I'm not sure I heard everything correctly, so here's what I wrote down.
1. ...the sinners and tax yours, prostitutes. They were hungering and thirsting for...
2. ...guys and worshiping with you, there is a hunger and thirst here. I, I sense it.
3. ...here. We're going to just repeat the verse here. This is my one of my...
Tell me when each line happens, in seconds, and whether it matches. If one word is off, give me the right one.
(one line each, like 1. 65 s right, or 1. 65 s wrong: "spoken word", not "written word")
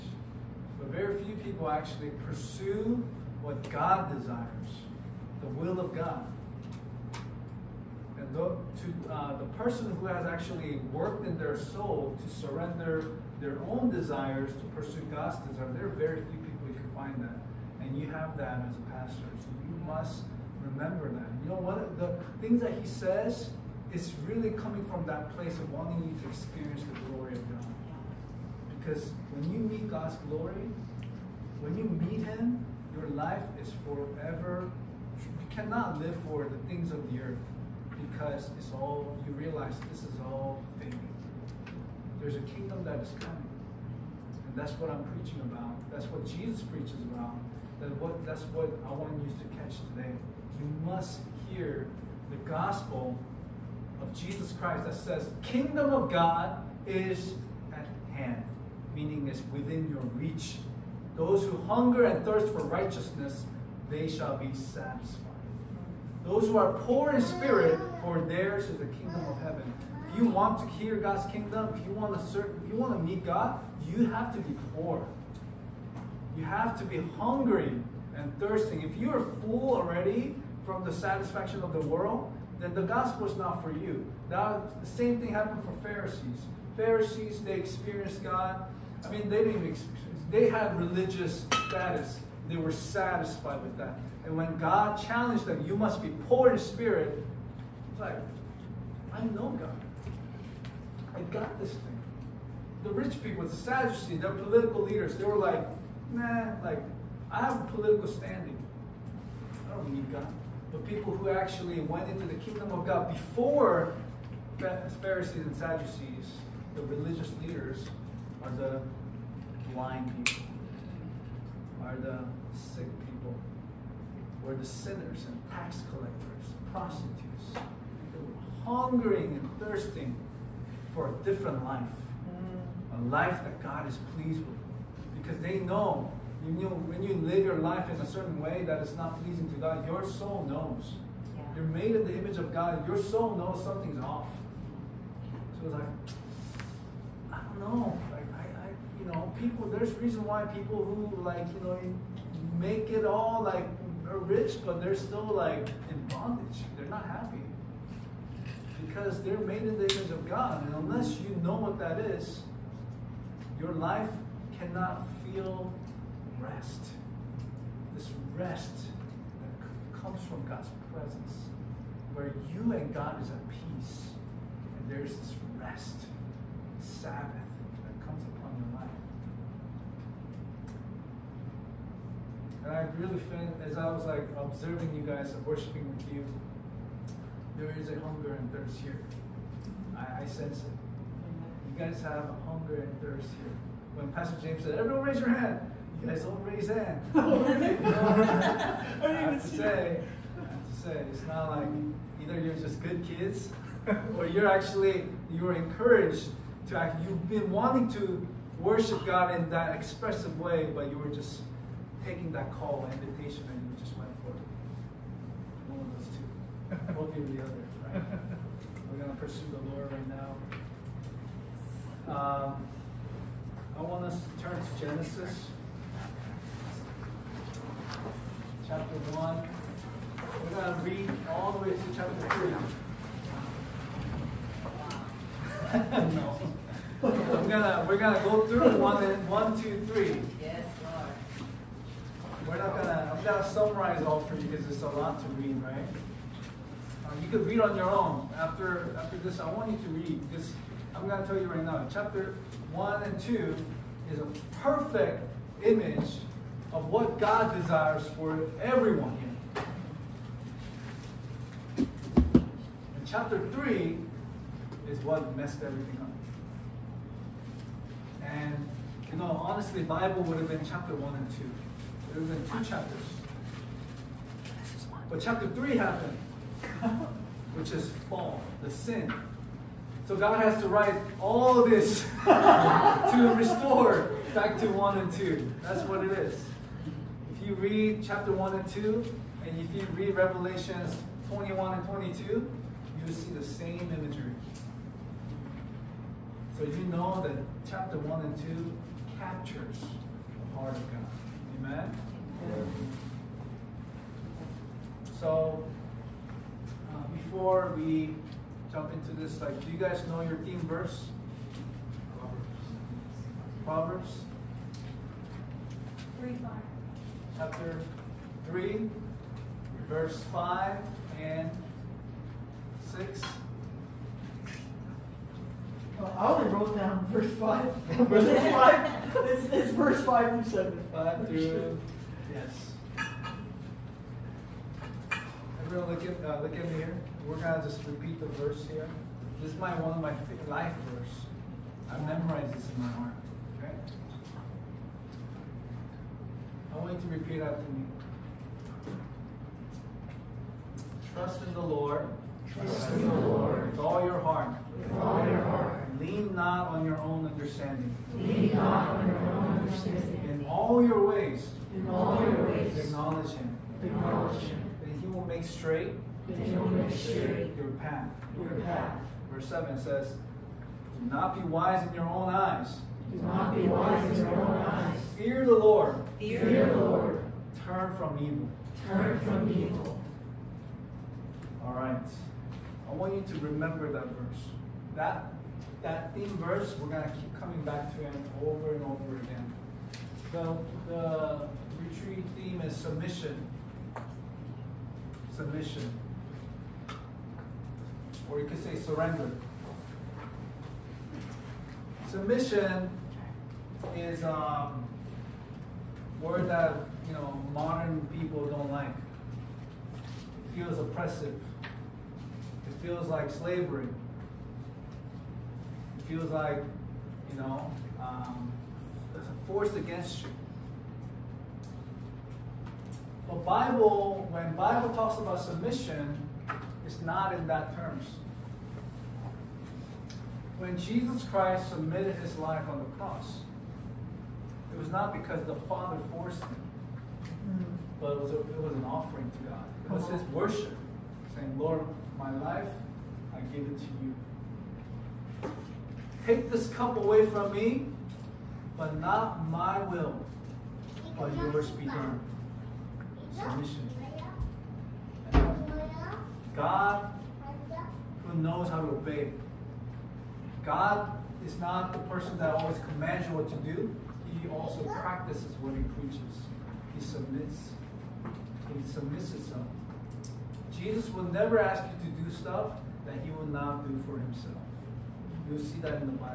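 1. 124 s wrong: "collectors", not "yours"
2. 185 s right
3. 336 s right.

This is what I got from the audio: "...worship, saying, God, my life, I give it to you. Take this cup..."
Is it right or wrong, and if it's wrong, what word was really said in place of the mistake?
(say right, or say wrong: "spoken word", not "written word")
wrong: "Lord", not "God".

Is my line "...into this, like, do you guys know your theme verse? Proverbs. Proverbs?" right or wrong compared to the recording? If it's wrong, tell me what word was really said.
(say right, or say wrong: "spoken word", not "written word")
right.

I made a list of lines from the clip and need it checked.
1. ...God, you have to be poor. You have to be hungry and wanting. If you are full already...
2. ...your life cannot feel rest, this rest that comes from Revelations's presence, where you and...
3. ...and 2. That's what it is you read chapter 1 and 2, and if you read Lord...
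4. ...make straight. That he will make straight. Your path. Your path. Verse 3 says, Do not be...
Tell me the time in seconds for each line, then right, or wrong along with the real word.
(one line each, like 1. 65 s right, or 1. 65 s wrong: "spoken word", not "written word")
1. 73 s wrong: "thirsting", not "wanting"
2. 163 s wrong: "God", not "Revelations"
3. 284 s wrong: "Revelations", not "Lord"
4. 365 s wrong: "7", not "3".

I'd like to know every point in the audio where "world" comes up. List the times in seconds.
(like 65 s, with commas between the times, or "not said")
81 s.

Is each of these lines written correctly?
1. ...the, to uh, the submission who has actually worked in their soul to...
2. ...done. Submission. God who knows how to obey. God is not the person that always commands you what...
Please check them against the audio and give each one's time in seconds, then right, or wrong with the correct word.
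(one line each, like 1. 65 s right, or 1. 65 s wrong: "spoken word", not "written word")
1. 8 s wrong: "person", not "submission"
2. 451 s right.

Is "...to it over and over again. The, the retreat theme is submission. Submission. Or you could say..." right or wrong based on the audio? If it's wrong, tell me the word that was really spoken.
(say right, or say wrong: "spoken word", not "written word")
right.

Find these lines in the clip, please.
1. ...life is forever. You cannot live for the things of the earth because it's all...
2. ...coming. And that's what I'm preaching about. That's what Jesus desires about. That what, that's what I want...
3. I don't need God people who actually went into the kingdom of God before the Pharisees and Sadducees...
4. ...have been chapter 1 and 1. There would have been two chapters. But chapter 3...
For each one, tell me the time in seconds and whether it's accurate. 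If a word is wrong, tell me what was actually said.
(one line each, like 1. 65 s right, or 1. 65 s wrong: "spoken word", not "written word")
1. 33 s right
2. 43 s wrong: "preaches", not "desires"
3. 109 s right
4. 270 s wrong: "2", not "1".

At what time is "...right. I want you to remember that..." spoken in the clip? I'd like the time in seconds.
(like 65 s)
381 s.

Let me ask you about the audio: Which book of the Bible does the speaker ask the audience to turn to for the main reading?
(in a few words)
Genesis.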